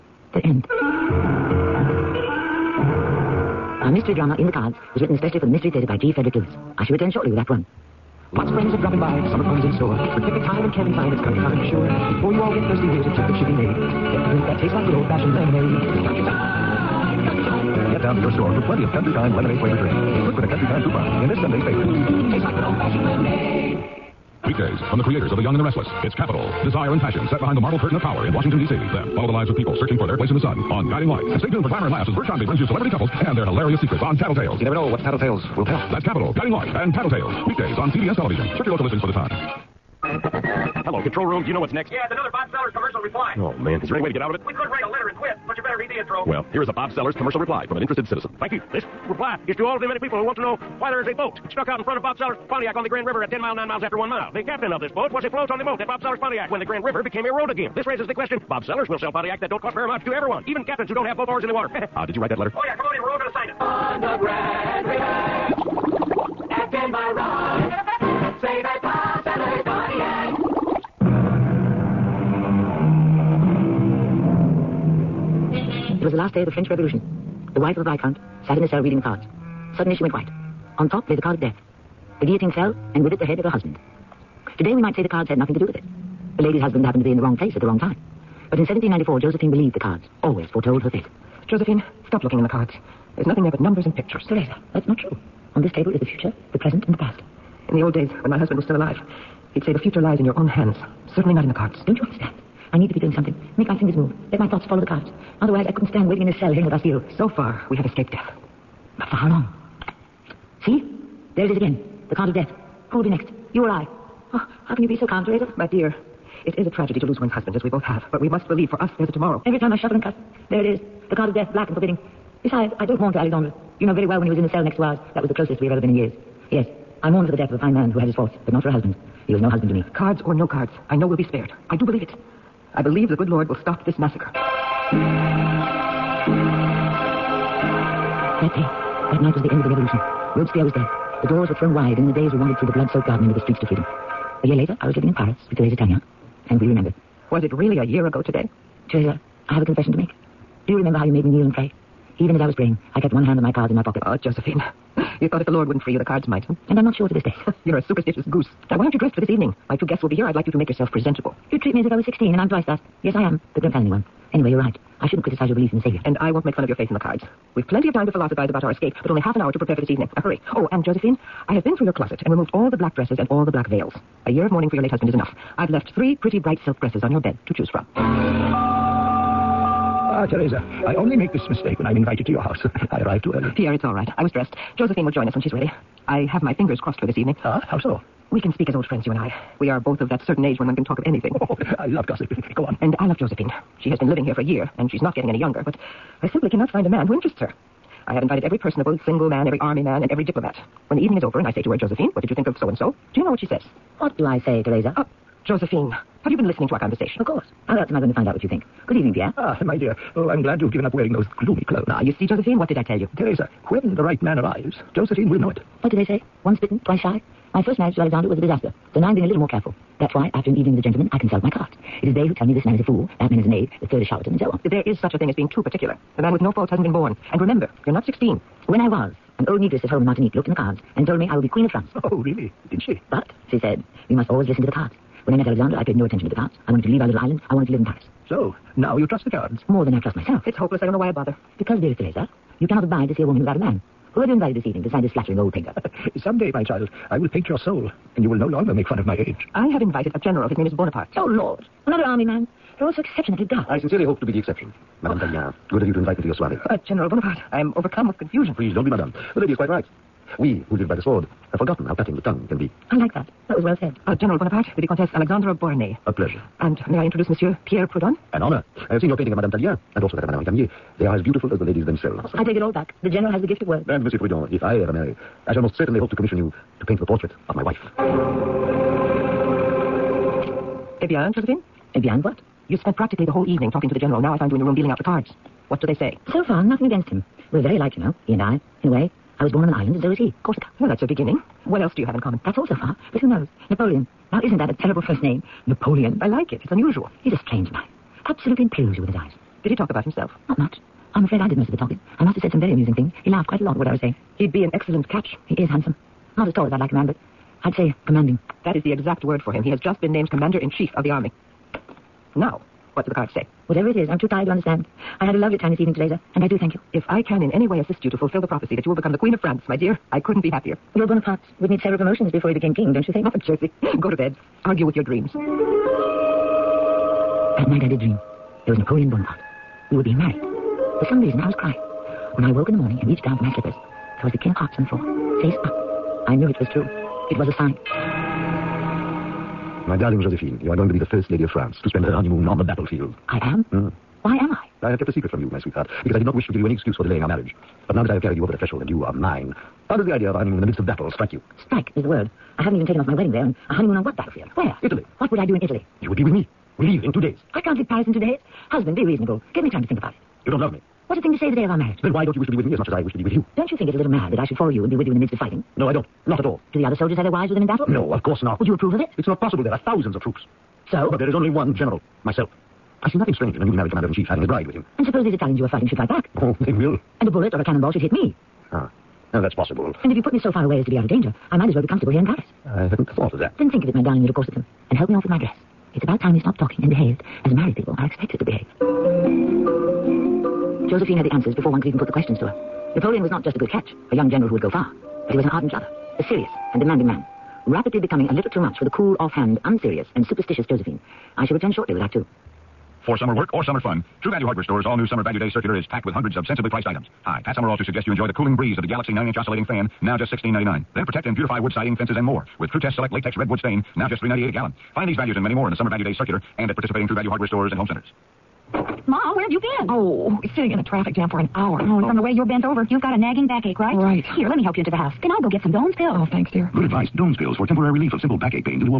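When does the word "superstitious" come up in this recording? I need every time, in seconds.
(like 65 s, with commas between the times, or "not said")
157 s, 400 s.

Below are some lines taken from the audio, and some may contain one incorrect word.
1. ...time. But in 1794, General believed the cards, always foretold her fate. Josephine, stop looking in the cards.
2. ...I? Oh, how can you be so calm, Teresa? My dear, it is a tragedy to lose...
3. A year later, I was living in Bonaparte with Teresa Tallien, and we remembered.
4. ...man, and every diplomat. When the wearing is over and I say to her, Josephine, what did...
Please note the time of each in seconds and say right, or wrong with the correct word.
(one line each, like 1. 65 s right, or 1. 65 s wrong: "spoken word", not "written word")
1. 87 s wrong: "Josephine", not "General"
2. 113 s right
3. 144 s wrong: "Paris", not "Bonaparte"
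4. 199 s wrong: "evening", not "wearing".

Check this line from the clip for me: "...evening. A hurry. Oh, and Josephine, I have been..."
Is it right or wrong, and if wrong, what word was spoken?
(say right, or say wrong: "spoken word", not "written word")
right.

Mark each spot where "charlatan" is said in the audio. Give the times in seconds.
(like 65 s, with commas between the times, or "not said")
224 s.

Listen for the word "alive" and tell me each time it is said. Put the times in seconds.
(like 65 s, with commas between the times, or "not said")
98 s.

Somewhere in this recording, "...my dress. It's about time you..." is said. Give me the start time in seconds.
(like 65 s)
385 s.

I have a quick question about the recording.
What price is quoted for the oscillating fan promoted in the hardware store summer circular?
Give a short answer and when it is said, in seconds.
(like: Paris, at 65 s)
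$16.99, at 410 s.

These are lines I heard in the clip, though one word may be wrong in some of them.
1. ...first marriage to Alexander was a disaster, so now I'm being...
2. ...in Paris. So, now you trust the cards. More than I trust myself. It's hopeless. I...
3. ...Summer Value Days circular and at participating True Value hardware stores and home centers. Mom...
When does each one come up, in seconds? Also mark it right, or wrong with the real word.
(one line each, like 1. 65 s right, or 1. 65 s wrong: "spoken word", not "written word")
1. 217 s right
2. 237 s right
3. 415 s right.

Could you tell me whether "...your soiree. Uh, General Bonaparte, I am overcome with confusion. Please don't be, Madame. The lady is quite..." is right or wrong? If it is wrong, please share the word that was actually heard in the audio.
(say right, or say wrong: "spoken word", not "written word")
right.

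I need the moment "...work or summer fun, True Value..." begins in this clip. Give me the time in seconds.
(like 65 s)
403 s.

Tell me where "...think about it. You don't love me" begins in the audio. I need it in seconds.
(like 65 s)
359 s.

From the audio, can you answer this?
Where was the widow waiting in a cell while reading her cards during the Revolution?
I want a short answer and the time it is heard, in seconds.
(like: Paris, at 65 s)
the Bastille, at 106 s.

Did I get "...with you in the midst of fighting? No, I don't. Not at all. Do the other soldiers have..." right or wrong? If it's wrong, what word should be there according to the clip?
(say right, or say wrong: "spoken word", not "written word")
right.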